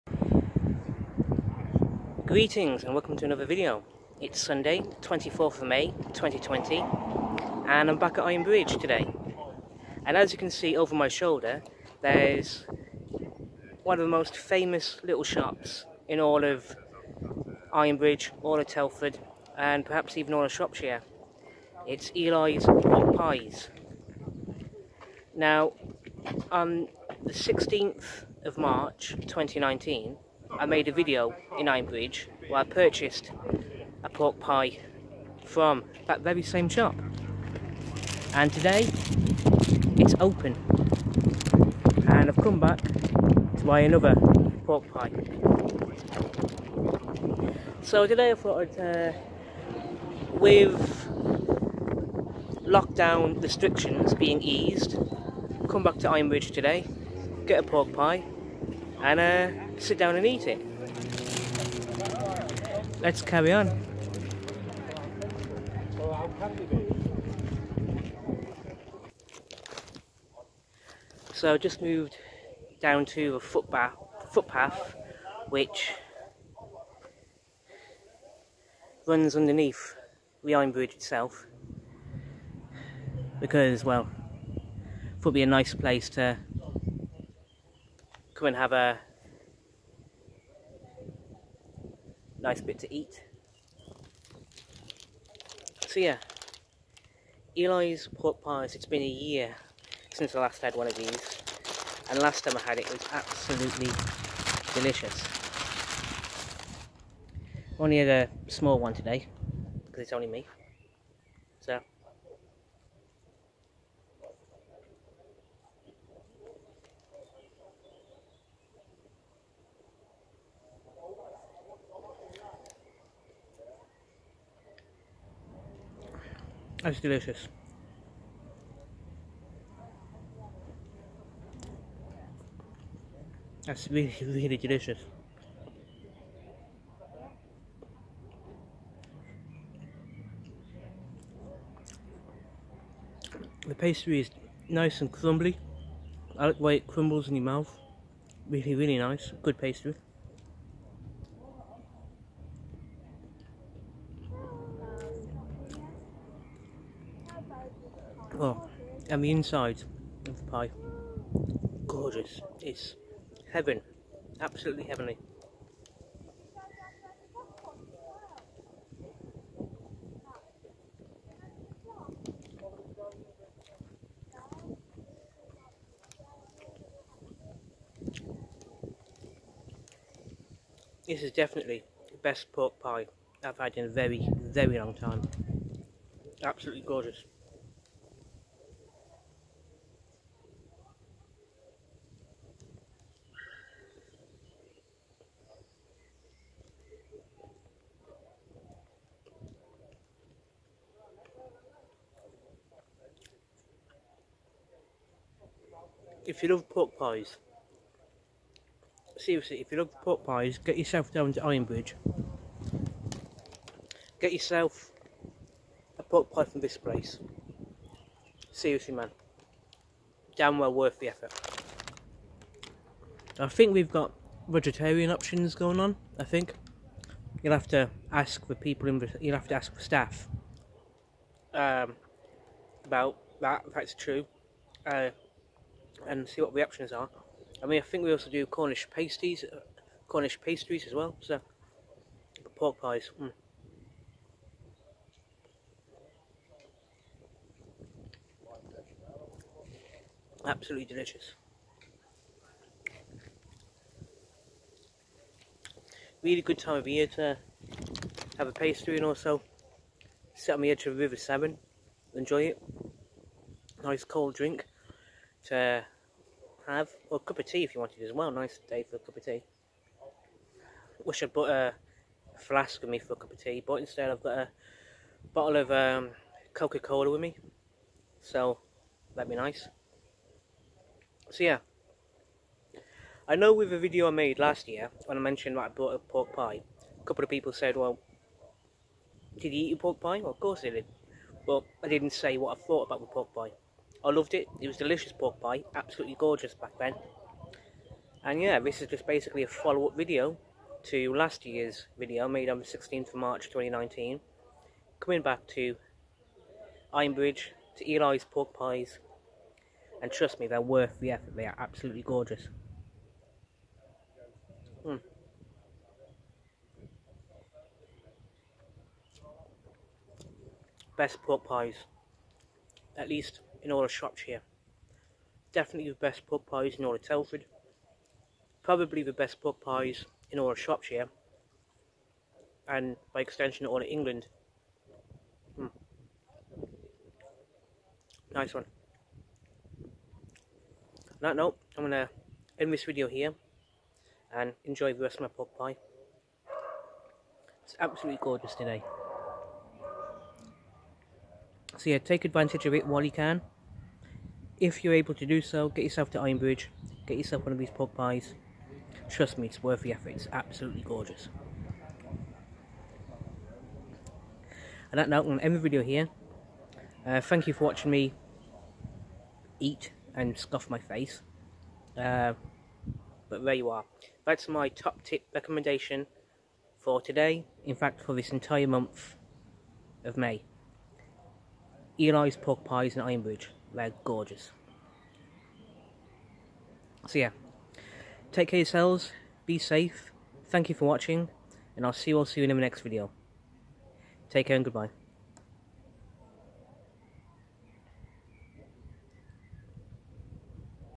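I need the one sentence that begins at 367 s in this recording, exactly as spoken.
Uh, thank you for watching me eat and scuff my face.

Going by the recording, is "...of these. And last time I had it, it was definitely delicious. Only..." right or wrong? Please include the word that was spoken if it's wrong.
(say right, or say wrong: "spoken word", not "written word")
wrong: "absolutely", not "definitely".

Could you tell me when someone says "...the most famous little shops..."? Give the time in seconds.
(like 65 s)
14 s.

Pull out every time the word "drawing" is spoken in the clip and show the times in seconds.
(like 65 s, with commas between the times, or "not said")
not said.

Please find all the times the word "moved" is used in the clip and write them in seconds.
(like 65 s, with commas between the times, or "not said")
71 s.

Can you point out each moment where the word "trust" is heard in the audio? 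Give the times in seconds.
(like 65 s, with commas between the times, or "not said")
310 s, 359 s.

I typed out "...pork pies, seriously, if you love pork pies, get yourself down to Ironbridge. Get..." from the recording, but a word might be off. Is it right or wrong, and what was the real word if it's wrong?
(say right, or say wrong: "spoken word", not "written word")
right.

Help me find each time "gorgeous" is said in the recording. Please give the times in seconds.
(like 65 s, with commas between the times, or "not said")
161 s, 186 s, 296 s, 312 s, 348 s, 360 s, 384 s.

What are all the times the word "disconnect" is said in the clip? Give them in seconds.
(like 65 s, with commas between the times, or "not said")
not said.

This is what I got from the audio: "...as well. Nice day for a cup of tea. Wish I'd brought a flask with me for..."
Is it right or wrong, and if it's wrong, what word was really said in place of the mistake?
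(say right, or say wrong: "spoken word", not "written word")
right.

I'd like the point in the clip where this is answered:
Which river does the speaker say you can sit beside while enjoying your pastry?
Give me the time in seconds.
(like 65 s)
260 s.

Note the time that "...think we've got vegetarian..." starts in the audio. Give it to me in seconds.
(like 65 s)
223 s.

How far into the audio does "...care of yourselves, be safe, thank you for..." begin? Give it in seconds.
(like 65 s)
388 s.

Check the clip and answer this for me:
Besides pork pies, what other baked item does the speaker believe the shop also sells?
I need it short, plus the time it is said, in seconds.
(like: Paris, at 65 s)
Cornish pasties, at 238 s.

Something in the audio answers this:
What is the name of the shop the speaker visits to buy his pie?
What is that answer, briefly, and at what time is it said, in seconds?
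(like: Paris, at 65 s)
Eley's Hot Pies, at 22 s.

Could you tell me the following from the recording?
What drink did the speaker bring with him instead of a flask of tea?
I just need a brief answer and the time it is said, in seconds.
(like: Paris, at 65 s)
Coca-Cola, at 276 s.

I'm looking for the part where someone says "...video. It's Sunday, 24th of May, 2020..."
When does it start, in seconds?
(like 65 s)
3 s.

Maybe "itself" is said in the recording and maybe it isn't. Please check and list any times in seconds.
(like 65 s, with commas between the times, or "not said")
80 s.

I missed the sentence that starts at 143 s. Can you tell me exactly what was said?
The pastry is nice and crumbly.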